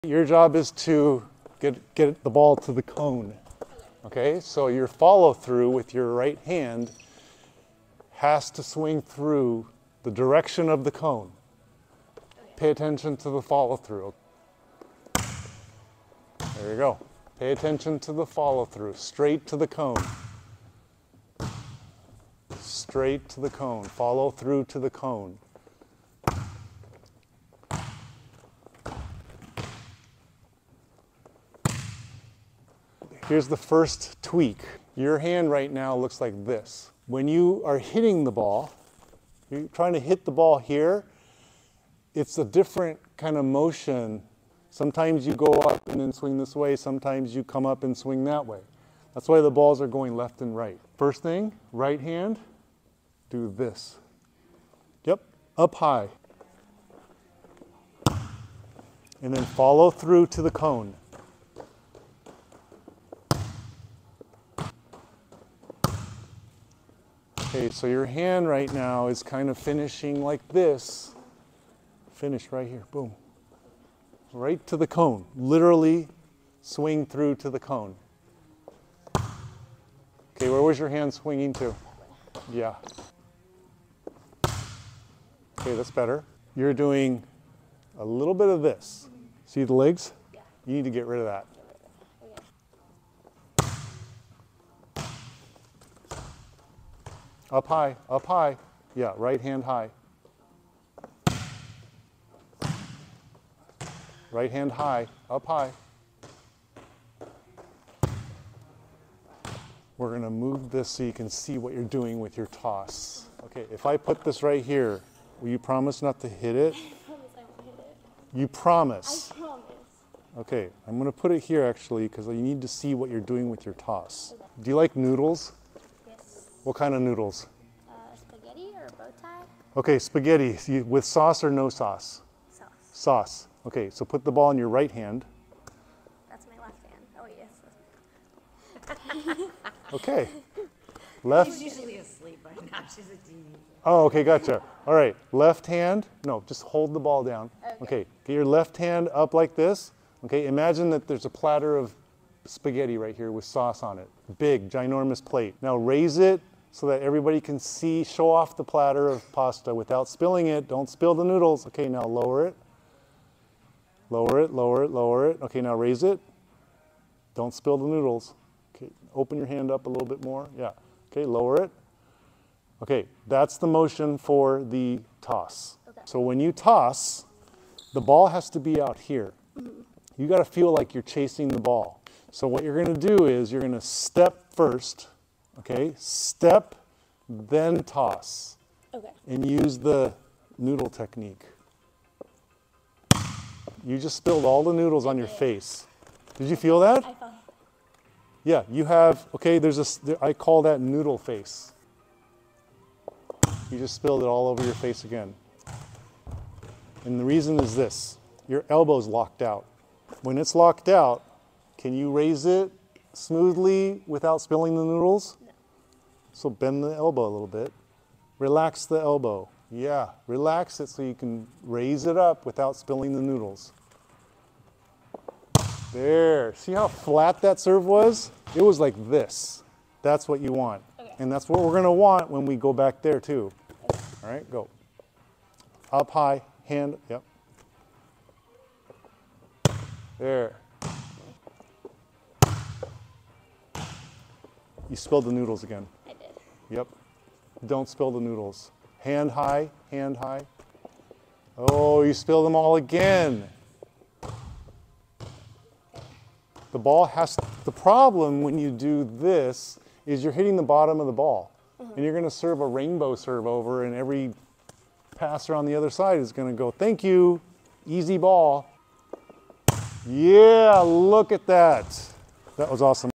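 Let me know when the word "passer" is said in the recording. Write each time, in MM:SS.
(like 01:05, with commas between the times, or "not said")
04:25.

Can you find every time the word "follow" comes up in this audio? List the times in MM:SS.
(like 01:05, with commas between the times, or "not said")
00:04, 00:13, 00:18, 00:23, 00:59.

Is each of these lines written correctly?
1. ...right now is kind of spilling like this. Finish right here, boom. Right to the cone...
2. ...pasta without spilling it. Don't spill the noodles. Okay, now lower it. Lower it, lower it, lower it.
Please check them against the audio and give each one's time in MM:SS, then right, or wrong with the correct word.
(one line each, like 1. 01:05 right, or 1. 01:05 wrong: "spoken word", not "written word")
1. 01:08 wrong: "finishing", not "spilling"
2. 02:39 right.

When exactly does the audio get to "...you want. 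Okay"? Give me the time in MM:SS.
03:50.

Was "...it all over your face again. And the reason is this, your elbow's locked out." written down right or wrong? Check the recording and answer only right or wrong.
right.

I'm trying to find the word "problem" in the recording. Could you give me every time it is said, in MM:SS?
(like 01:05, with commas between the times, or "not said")
04:17.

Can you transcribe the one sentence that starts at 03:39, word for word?
Yeah, relax it so you can raise it up without spilling the noodles.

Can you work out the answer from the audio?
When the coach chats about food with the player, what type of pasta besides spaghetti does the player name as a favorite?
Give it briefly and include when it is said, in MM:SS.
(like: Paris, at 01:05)
Bow tie, at 02:08.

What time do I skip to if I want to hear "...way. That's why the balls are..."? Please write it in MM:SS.
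00:48.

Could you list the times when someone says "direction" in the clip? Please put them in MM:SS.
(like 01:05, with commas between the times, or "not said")
00:10.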